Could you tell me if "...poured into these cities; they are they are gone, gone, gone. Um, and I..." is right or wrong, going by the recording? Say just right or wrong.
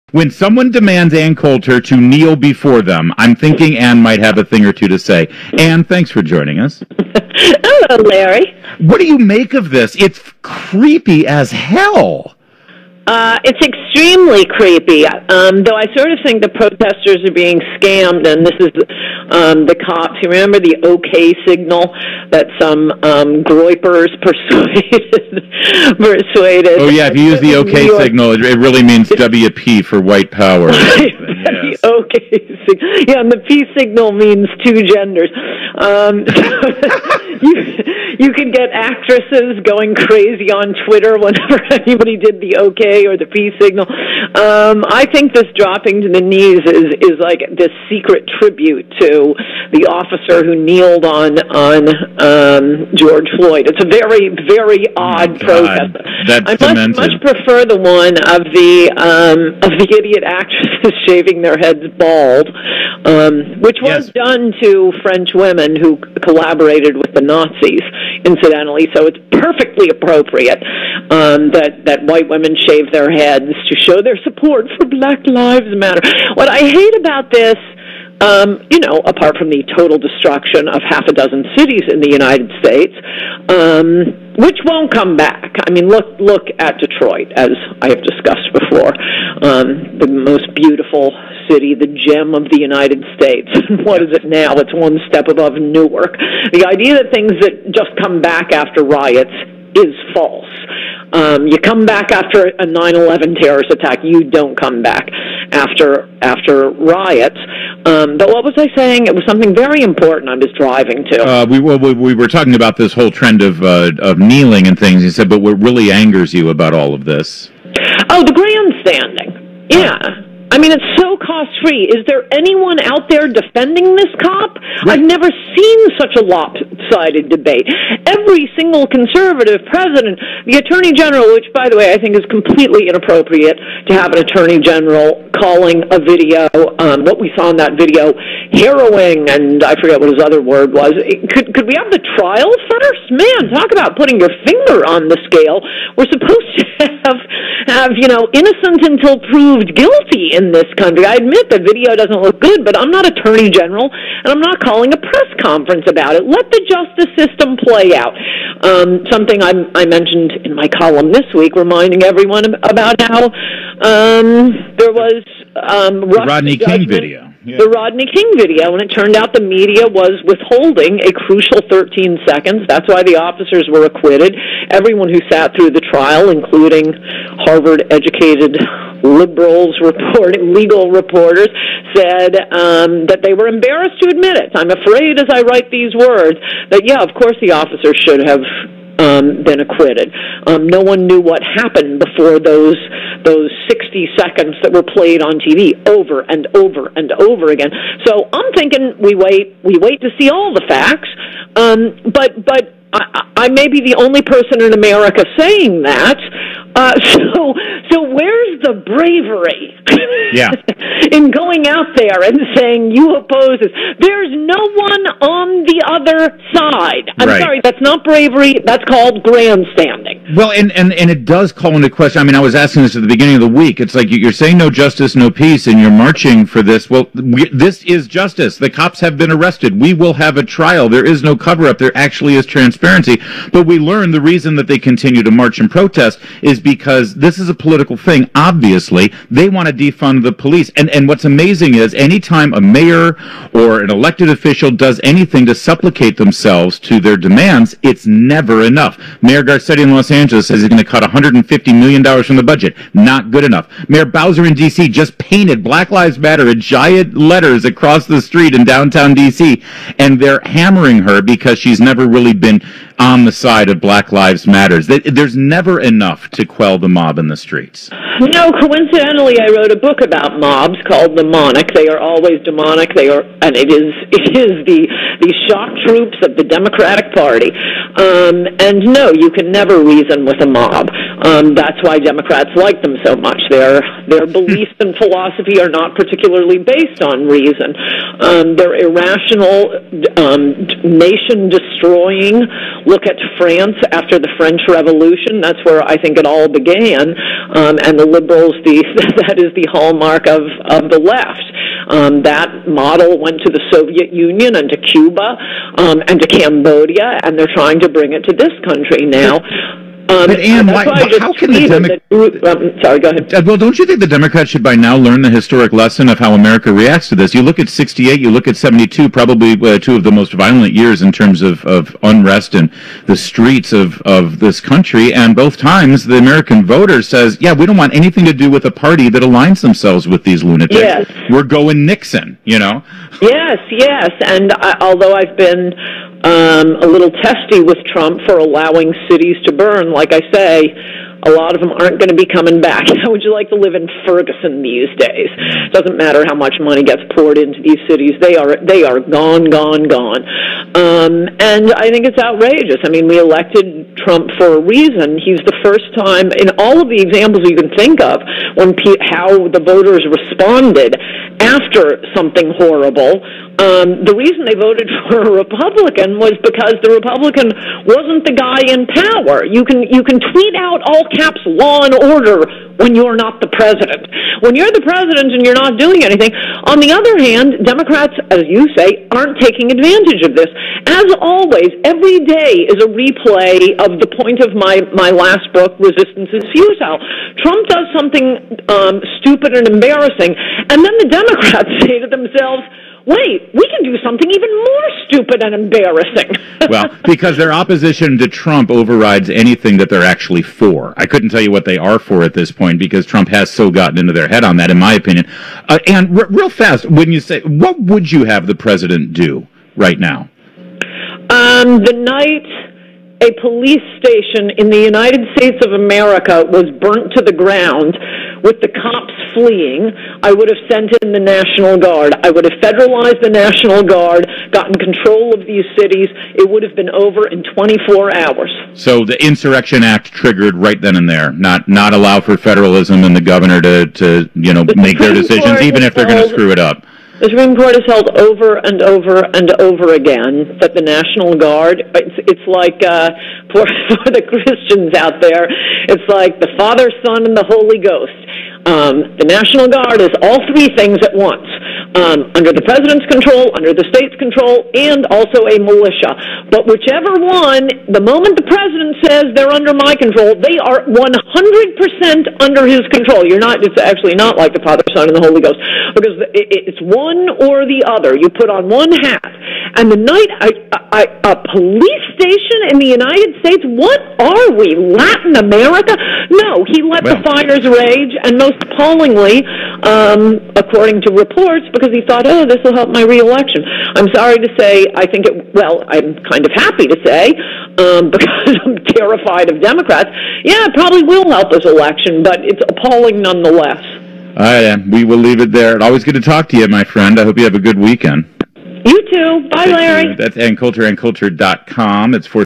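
right.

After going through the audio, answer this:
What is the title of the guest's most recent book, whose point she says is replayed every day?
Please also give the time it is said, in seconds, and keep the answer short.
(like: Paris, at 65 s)
Resistance is Futile, at 385 s.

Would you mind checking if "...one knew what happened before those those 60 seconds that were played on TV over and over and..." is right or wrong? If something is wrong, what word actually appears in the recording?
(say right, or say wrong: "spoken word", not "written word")
right.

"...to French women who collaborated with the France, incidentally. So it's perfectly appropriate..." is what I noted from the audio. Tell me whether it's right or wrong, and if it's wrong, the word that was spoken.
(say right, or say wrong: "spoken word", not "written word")
wrong: "Nazis", not "France".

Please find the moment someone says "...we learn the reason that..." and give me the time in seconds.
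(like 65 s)
233 s.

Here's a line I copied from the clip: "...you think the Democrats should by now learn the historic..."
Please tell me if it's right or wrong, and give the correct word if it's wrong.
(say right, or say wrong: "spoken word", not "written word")
right.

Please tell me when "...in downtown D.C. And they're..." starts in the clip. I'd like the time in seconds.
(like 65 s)
258 s.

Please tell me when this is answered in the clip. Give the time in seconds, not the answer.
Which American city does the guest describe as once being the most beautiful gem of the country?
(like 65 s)
86 s.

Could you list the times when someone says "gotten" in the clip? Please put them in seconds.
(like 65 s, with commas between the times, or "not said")
403 s, 424 s.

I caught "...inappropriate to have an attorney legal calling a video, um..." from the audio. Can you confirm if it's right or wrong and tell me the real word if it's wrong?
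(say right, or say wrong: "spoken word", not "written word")
wrong: "general", not "legal".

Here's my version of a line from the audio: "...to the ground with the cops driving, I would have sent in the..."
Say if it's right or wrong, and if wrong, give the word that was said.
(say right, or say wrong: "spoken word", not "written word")
wrong: "fleeing", not "driving".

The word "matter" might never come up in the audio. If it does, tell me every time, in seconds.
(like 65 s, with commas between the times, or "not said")
75 s, 256 s, 264 s, 345 s.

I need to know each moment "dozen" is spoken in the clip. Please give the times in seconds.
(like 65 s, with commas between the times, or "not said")
81 s.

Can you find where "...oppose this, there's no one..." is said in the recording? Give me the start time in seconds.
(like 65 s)
213 s.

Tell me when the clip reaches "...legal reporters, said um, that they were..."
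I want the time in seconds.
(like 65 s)
180 s.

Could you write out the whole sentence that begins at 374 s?
When you're the president and you're not doing anything, on the other hand, Democrats, as you say, aren't taking advantage of this.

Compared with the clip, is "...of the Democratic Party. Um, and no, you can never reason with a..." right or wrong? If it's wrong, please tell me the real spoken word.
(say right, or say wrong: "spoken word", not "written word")
right.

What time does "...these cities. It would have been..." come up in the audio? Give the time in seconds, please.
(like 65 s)
425 s.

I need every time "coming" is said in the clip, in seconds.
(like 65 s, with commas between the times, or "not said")
342 s.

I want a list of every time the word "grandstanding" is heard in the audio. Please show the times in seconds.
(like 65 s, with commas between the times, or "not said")
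118 s, 219 s.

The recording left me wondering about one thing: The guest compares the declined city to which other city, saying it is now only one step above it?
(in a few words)
Newark.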